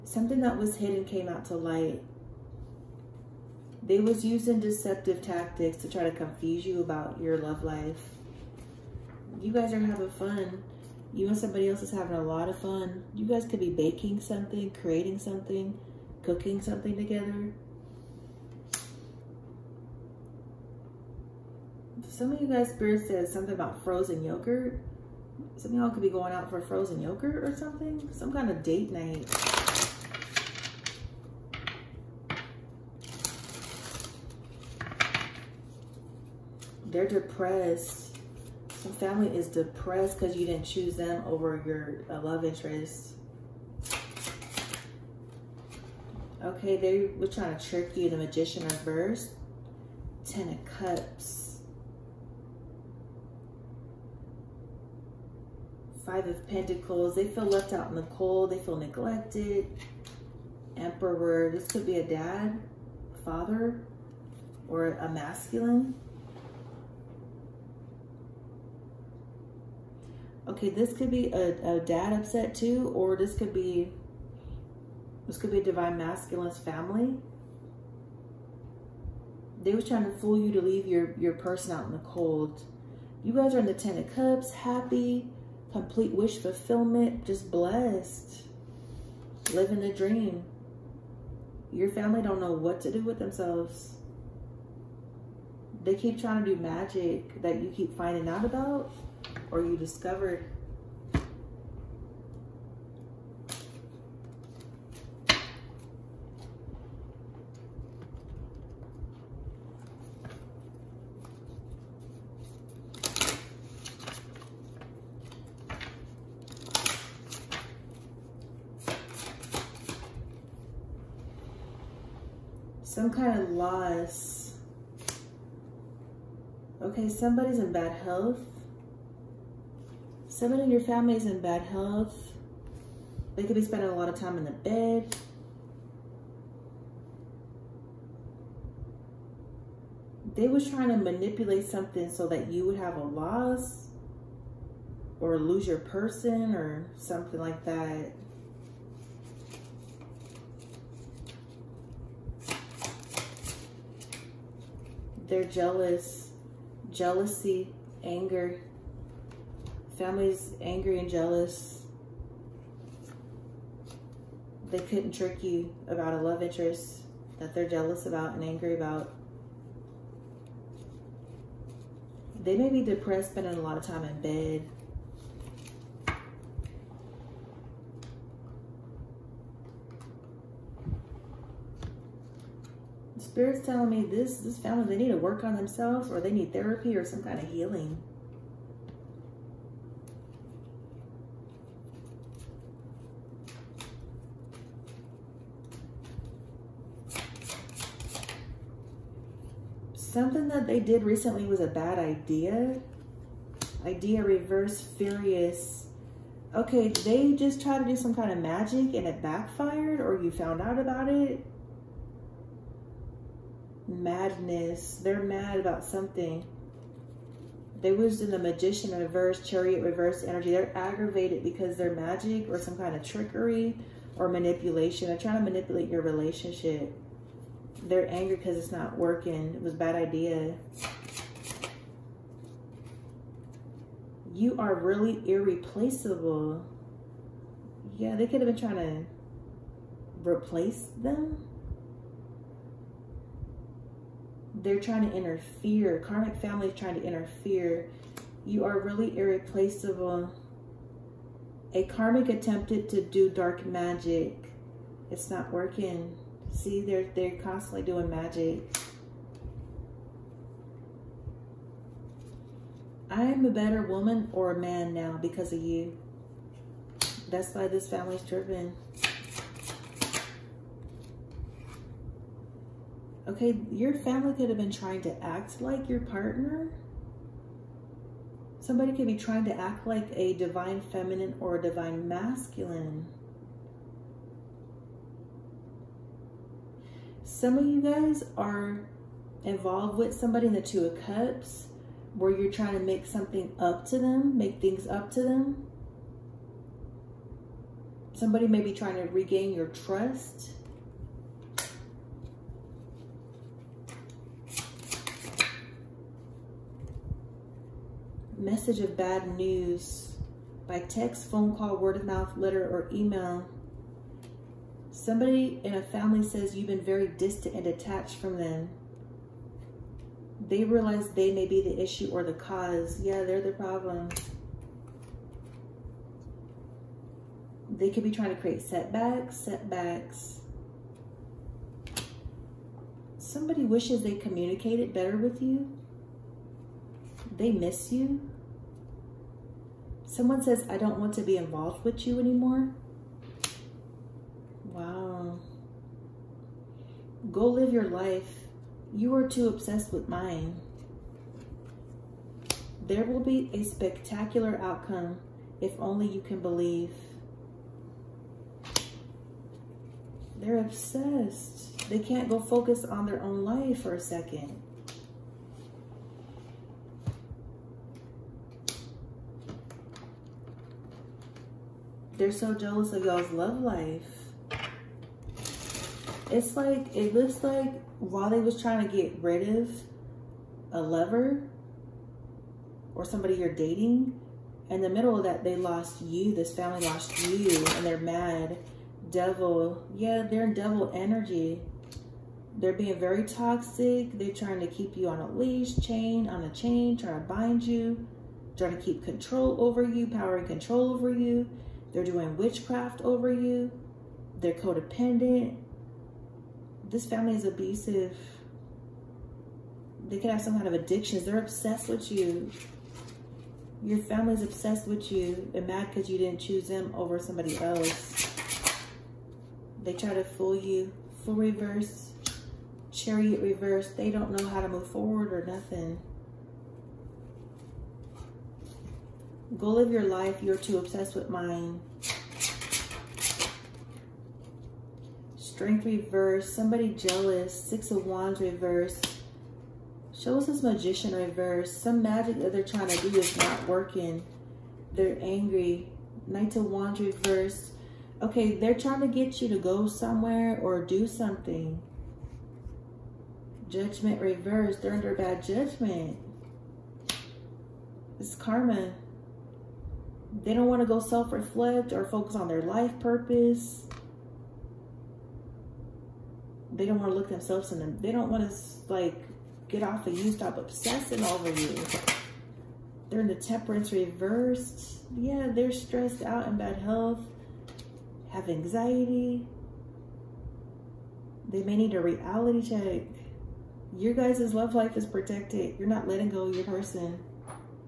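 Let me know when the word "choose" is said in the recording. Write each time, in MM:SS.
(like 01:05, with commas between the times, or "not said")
00:40, 06:56.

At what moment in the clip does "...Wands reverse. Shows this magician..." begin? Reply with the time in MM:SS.
07:18.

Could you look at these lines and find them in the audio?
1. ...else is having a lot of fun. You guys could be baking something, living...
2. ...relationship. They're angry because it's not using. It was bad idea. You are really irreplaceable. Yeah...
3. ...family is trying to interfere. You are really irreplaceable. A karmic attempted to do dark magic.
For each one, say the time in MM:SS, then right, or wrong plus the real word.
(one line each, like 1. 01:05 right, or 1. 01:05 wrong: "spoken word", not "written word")
1. 00:11 wrong: "creating", not "living"
2. 03:46 wrong: "working", not "using"
3. 04:06 right.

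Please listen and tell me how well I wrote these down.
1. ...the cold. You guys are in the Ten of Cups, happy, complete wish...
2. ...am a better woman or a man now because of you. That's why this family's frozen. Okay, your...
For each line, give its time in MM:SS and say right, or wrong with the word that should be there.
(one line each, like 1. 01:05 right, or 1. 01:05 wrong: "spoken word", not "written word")
1. 01:21 right
2. 04:23 wrong: "driven", not "frozen".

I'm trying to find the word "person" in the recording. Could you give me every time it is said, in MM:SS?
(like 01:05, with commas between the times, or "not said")
01:21, 02:25, 08:06.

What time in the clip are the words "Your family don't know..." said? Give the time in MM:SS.
01:31.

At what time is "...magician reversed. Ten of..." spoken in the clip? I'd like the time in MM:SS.
00:48.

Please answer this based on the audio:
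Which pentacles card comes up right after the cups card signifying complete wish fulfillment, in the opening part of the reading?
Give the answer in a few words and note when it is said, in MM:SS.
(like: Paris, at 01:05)
Five of Pentacles, at 00:56.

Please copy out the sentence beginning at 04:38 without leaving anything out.
Somebody could be trying to act like a divine feminine or a divine masculine.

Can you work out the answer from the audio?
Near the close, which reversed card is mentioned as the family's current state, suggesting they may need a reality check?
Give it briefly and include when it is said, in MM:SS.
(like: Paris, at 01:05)
Temperance, at 07:53.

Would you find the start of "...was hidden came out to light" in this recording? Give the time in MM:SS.
00:00.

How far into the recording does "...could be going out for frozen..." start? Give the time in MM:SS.
00:25.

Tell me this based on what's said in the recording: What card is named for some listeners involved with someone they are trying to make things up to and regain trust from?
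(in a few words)
Two of Cups.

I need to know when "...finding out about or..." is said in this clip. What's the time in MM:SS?
01:37.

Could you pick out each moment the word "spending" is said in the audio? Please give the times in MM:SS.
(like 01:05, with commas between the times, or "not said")
02:13, 02:53.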